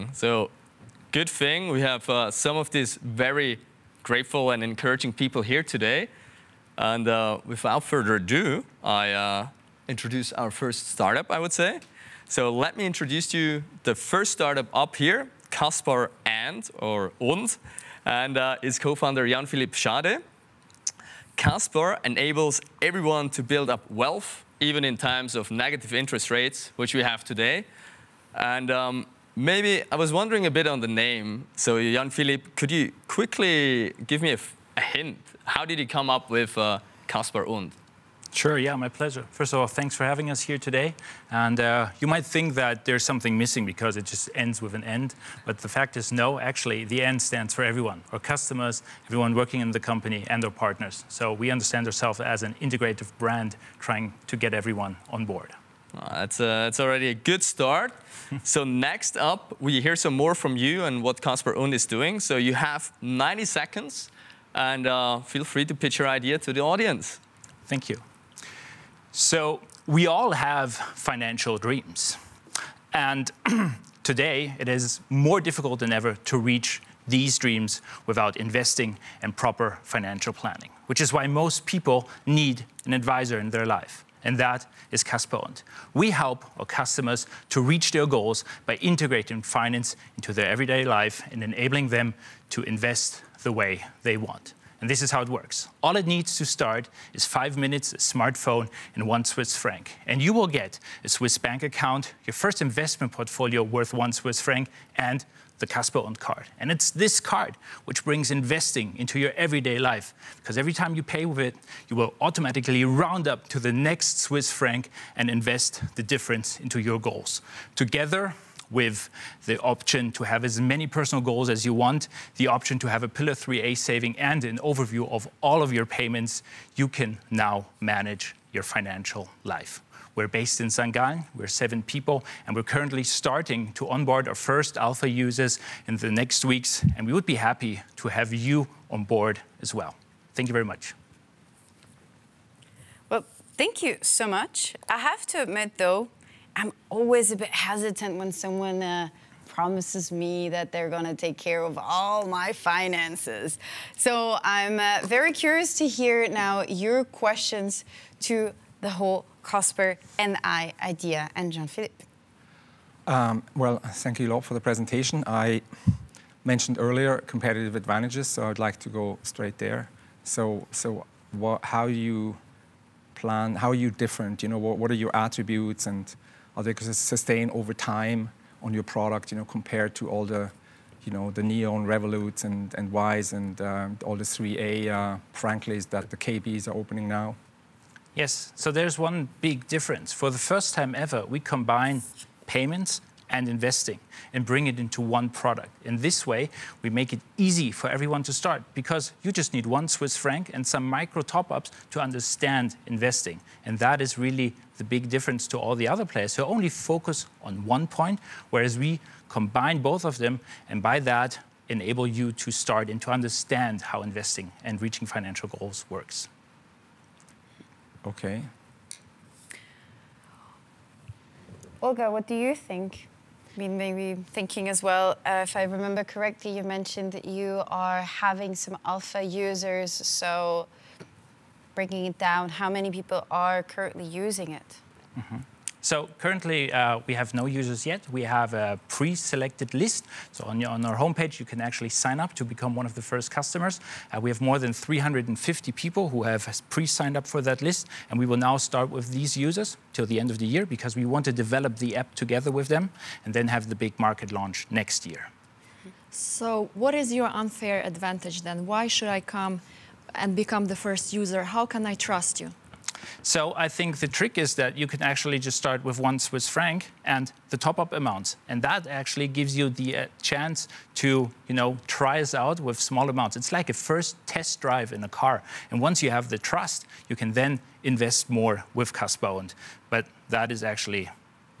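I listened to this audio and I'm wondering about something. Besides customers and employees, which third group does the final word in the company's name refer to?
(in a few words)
partners.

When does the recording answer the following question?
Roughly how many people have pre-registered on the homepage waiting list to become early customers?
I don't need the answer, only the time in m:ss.
4:04.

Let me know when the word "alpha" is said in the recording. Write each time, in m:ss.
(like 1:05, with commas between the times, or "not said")
2:14, 3:48.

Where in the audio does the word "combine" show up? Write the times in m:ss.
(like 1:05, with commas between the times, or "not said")
3:11, 3:29.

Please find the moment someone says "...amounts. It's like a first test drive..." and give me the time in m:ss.
4:33.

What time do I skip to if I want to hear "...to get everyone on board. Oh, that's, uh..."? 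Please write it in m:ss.
0:54.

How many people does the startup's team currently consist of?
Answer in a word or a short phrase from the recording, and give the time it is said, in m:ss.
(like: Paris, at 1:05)
7, at 2:11.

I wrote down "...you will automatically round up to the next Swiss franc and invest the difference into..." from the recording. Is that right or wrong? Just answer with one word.
right.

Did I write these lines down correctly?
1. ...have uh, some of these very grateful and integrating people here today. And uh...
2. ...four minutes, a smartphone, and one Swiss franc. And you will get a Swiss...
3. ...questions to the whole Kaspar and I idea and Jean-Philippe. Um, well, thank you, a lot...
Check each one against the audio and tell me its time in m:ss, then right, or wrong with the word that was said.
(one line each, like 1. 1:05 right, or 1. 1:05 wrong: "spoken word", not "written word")
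1. 0:01 wrong: "encouraging", not "integrating"
2. 1:37 wrong: "five", not "four"
3. 2:37 right.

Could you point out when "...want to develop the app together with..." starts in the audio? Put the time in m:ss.
4:11.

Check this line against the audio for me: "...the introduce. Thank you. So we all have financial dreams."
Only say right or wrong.
wrong.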